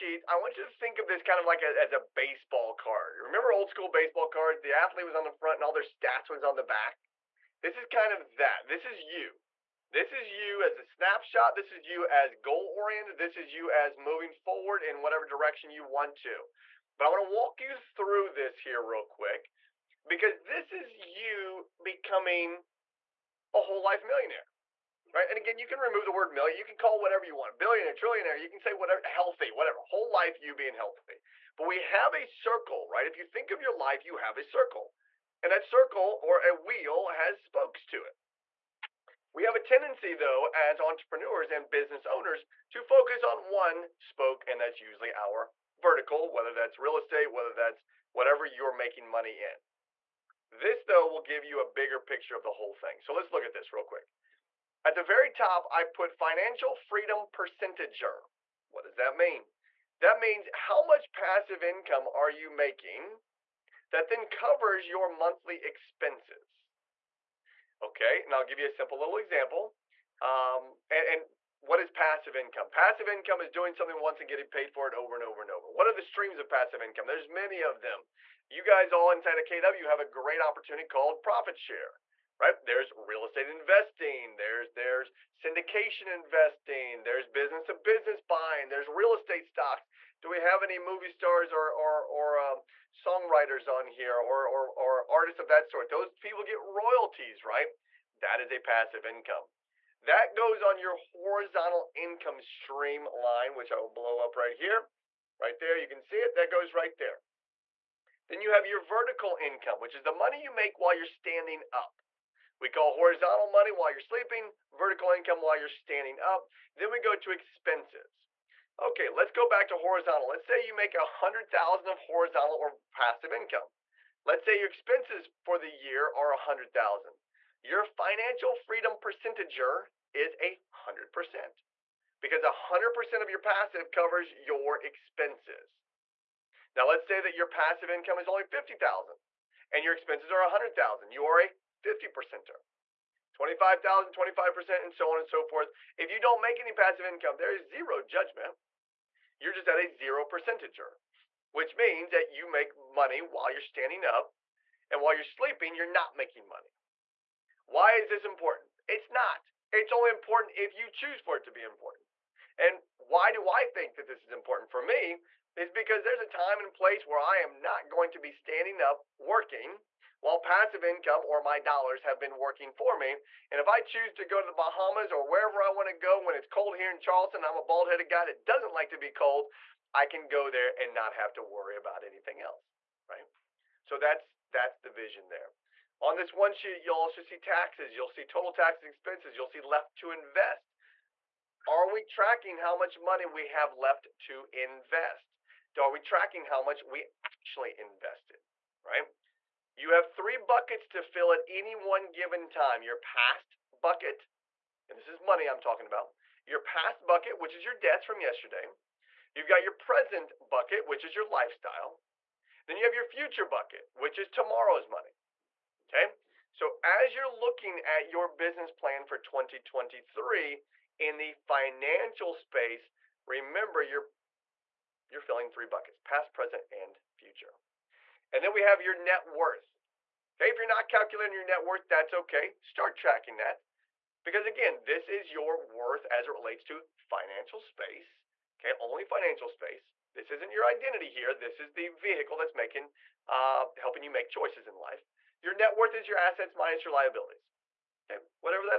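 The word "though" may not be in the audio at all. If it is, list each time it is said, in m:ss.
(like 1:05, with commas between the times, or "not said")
0:40, 0:50.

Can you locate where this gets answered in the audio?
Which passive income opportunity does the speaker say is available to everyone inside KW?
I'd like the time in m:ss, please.
1:21.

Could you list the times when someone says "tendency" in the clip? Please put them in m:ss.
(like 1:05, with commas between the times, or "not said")
0:39.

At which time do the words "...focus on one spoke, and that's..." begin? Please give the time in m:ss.
0:42.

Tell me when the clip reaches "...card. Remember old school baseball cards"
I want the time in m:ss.
0:02.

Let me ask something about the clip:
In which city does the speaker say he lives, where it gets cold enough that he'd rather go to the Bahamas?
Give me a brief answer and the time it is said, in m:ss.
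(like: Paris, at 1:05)
Charleston, at 2:56.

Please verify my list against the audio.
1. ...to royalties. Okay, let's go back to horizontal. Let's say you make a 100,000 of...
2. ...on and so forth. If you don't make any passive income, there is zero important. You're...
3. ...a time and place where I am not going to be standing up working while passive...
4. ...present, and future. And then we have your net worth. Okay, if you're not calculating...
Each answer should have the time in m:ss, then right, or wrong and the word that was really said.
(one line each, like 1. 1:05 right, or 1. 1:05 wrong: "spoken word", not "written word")
1. 1:57 wrong: "expenses", not "royalties"
2. 2:25 wrong: "judgment", not "important"
3. 2:46 right
4. 3:46 right.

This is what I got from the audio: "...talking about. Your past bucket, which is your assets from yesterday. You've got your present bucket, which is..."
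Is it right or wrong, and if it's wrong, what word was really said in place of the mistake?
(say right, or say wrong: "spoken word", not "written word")
wrong: "debts", not "assets".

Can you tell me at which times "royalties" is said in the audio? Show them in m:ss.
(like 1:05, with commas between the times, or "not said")
1:36.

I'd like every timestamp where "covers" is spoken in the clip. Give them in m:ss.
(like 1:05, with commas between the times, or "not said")
1:04, 2:13.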